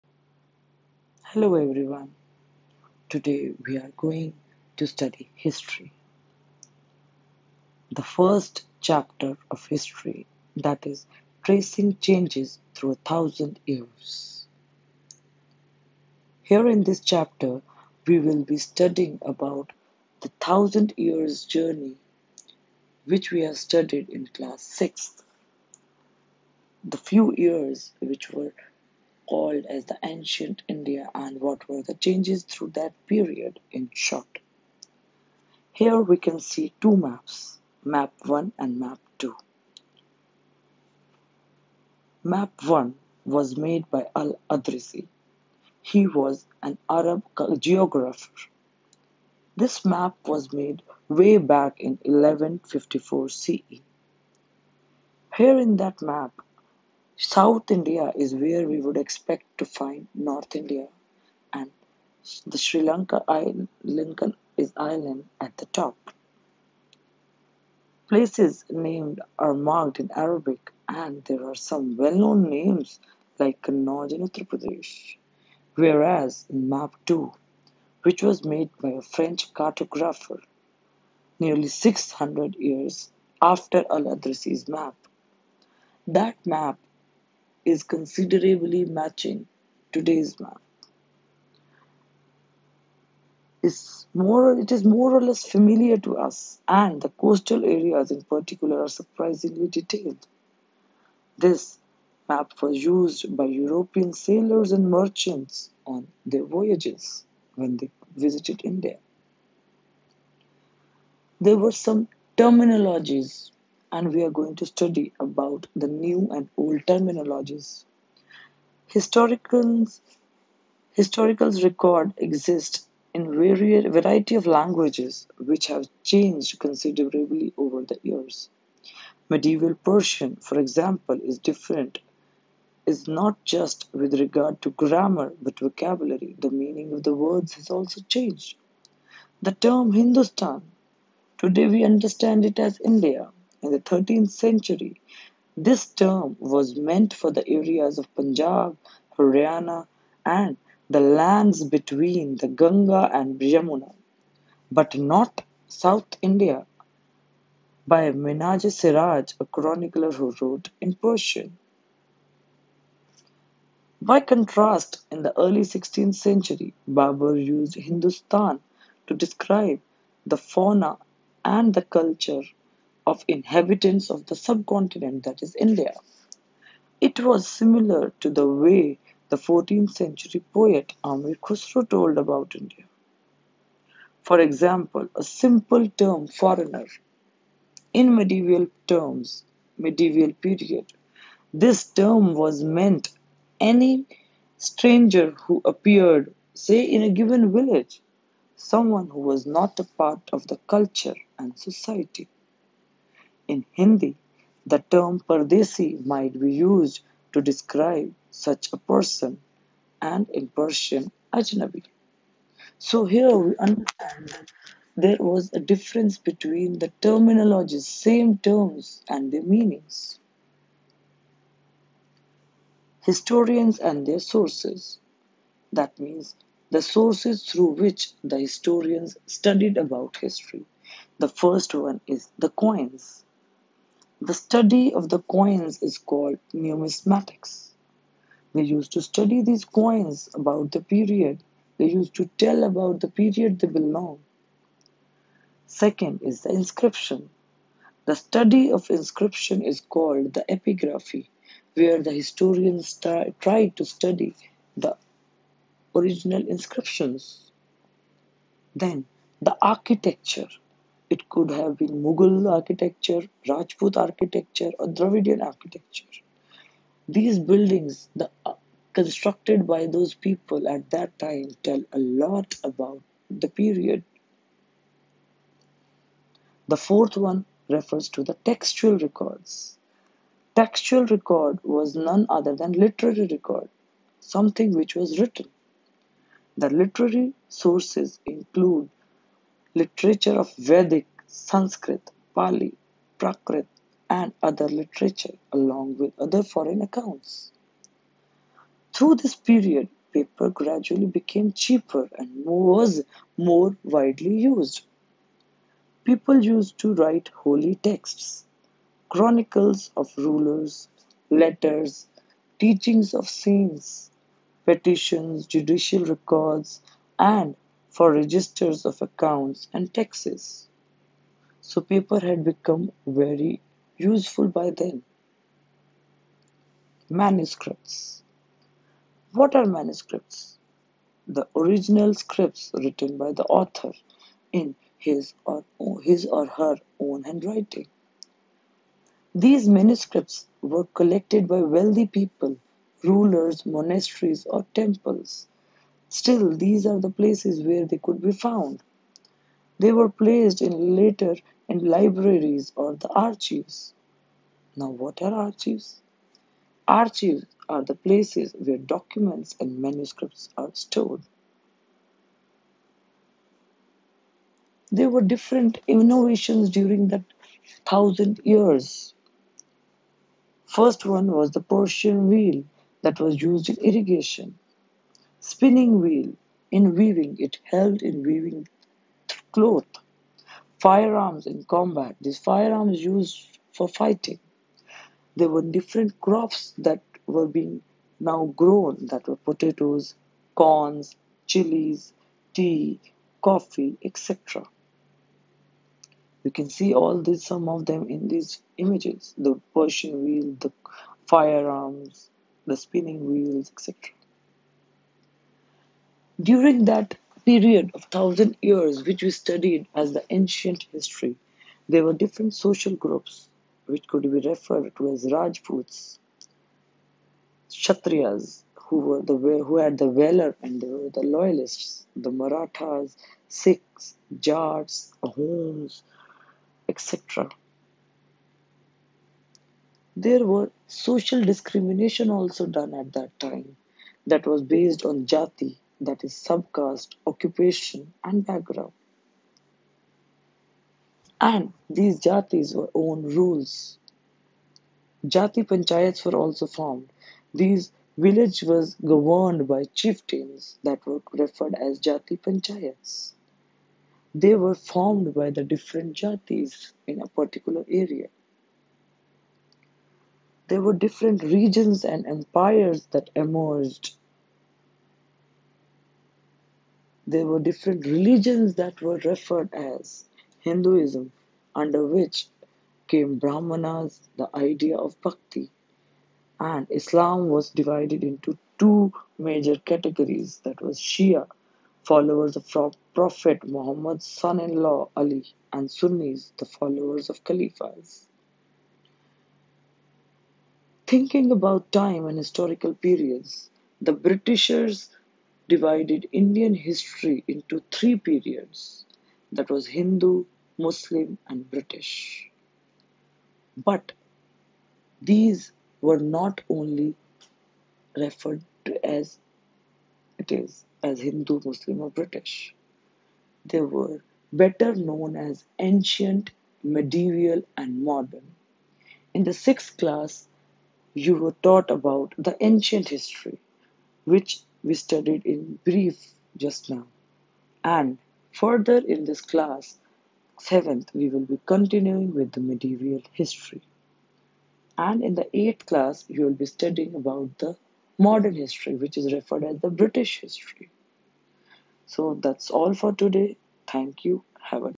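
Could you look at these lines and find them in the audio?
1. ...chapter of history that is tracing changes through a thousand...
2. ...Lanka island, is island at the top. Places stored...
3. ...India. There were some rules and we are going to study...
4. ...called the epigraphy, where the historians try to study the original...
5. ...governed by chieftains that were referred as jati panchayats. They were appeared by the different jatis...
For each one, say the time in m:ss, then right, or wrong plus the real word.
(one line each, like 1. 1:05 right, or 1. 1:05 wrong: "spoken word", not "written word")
1. 0:08 right
2. 1:02 wrong: "named", not "stored"
3. 1:48 wrong: "terminologies", not "rules"
4. 4:09 right
5. 7:28 wrong: "formed", not "appeared".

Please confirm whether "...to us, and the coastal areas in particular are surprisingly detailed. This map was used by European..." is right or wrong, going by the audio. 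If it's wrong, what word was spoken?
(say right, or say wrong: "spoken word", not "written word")
right.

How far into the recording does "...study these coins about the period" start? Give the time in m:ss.
3:59.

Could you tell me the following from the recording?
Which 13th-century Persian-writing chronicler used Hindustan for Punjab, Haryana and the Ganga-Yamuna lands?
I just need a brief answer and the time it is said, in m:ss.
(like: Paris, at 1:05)
Minhaj Siraj, at 2:38.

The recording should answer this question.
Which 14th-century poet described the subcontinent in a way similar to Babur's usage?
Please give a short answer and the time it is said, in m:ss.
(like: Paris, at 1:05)
Amir Khusro, at 3:01.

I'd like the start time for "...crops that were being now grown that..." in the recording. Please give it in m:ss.
6:26.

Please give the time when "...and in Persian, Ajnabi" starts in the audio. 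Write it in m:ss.
3:30.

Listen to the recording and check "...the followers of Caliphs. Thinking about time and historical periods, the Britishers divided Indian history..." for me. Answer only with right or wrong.
right.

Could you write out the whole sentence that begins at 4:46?
The literary sources include literature of Vedic, Sanskrit, Pali, Prakrit, and other literature, along with other foreign accounts.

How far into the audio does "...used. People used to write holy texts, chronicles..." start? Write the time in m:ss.
5:04.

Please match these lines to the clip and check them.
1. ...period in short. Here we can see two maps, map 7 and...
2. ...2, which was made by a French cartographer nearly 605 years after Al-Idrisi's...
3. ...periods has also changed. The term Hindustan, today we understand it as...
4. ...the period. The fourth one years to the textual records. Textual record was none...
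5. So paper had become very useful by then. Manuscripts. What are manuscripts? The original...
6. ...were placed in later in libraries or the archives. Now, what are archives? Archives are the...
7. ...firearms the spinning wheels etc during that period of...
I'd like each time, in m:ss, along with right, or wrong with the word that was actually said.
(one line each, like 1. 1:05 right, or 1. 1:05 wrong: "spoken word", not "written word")
1. 0:33 wrong: "1", not "7"
2. 1:17 wrong: "600", not "605"
3. 2:17 wrong: "words", not "periods"
4. 4:33 wrong: "refers", not "years"
5. 5:21 right
6. 5:49 right
7. 6:41 right.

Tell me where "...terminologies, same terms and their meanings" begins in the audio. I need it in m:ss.
3:37.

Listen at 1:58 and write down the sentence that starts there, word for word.
Historicals, historicals record exist in variety of languages which have changed considerably over the years.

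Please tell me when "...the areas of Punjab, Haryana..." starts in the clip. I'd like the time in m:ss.
2:27.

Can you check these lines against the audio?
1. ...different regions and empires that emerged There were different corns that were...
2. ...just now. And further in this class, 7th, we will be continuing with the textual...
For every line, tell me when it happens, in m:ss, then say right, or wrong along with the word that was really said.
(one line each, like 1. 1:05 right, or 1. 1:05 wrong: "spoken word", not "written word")
1. 7:40 wrong: "religions", not "corns"
2. 8:46 wrong: "medieval", not "textual".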